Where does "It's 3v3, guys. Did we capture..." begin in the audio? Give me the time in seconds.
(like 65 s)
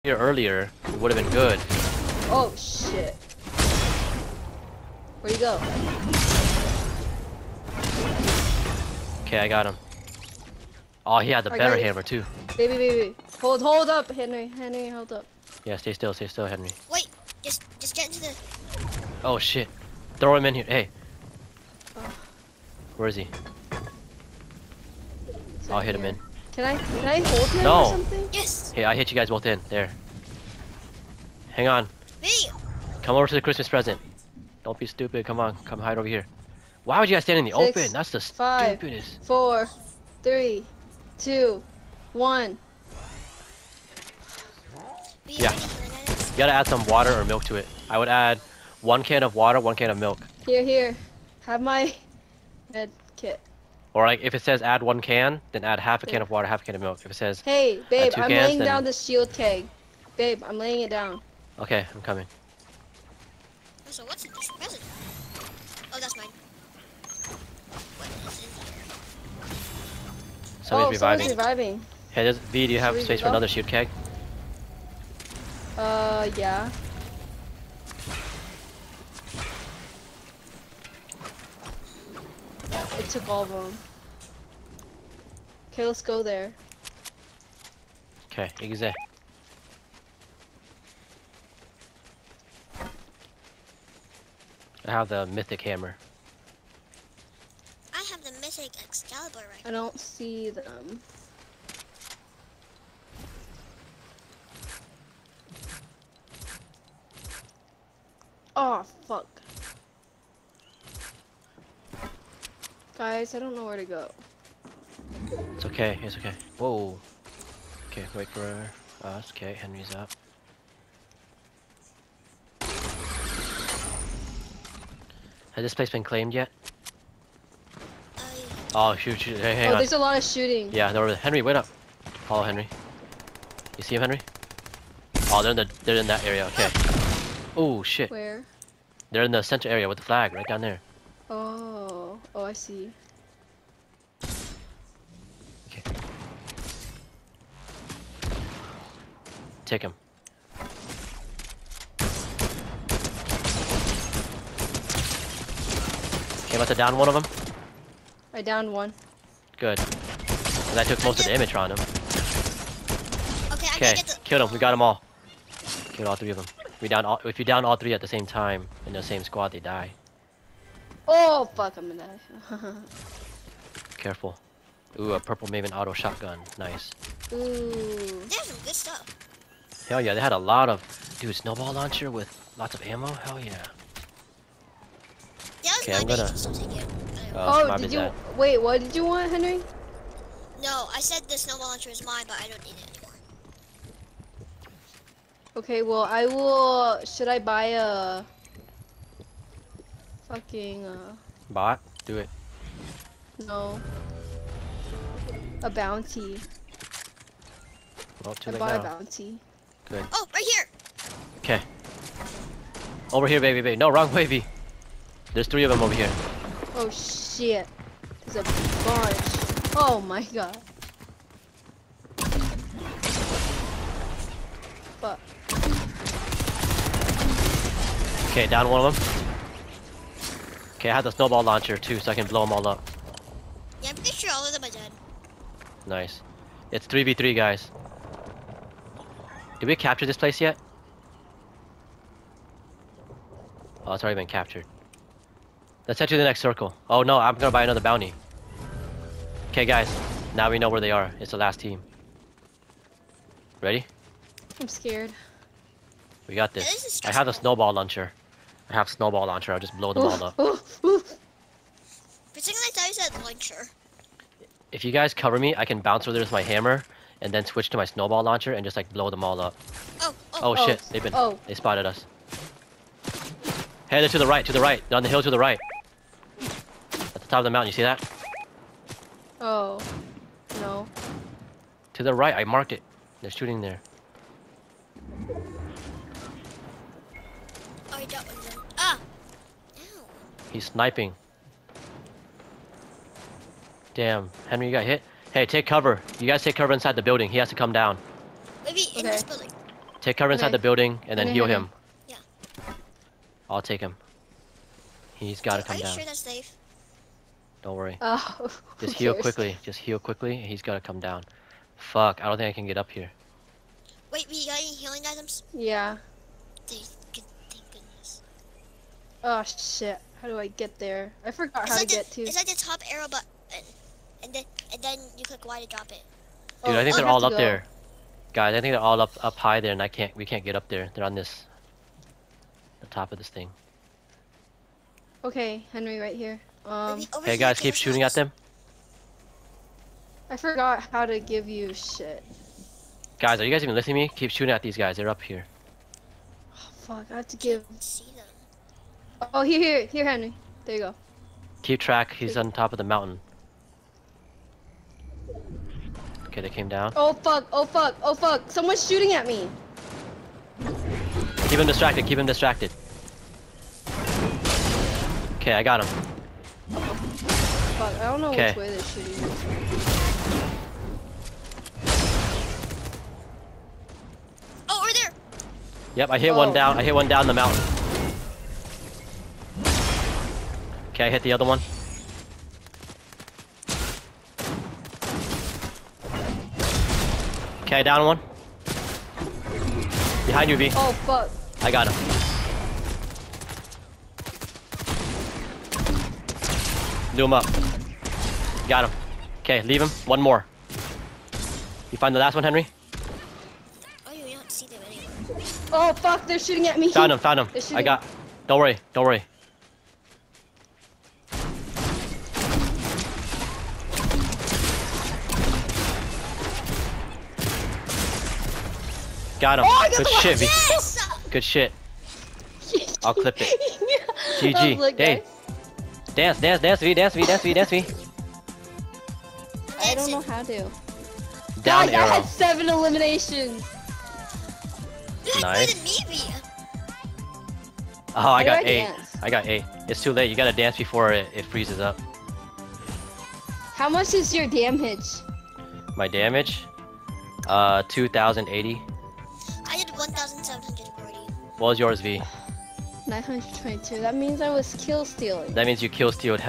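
236 s.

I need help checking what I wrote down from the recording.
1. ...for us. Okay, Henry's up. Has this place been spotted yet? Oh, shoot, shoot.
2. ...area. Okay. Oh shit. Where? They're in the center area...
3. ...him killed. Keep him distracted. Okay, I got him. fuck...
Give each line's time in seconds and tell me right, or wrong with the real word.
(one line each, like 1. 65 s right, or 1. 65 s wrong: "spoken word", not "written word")
1. 118 s wrong: "claimed", not "spotted"
2. 136 s right
3. 361 s wrong: "distracted", not "killed".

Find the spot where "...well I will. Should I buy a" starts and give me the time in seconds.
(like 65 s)
195 s.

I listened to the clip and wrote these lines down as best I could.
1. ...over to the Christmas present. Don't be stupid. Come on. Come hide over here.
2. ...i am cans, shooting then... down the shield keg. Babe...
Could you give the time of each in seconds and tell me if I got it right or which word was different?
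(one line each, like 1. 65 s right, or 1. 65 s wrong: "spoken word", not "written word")
1. 33 s right
2. 58 s wrong: "laying", not "shooting".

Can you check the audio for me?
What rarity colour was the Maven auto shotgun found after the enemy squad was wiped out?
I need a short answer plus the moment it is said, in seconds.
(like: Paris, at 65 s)
Purple, at 175 s.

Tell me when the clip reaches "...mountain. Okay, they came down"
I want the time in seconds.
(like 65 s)
352 s.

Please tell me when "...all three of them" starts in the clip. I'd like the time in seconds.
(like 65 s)
166 s.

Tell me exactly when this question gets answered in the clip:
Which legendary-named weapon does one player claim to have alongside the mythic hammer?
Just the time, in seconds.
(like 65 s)
98 s.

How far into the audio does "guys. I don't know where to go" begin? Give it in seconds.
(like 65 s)
113 s.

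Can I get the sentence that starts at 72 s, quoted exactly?
Hey, does, V, do you have Should space for another shield keg?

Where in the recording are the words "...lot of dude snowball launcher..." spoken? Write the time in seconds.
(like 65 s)
180 s.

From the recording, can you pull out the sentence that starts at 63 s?
Oh, so what's in this present?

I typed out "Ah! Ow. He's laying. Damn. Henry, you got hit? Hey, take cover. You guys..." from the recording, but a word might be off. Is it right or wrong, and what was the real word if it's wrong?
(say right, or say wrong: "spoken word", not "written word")
wrong: "sniping", not "laying".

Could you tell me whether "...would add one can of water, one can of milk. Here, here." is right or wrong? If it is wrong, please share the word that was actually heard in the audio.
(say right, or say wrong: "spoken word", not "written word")
right.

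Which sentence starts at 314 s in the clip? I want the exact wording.
Wait, we got any healing items?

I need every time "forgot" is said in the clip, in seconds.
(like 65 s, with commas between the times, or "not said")
321 s, 340 s.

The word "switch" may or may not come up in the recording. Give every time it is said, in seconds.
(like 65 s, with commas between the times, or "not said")
267 s.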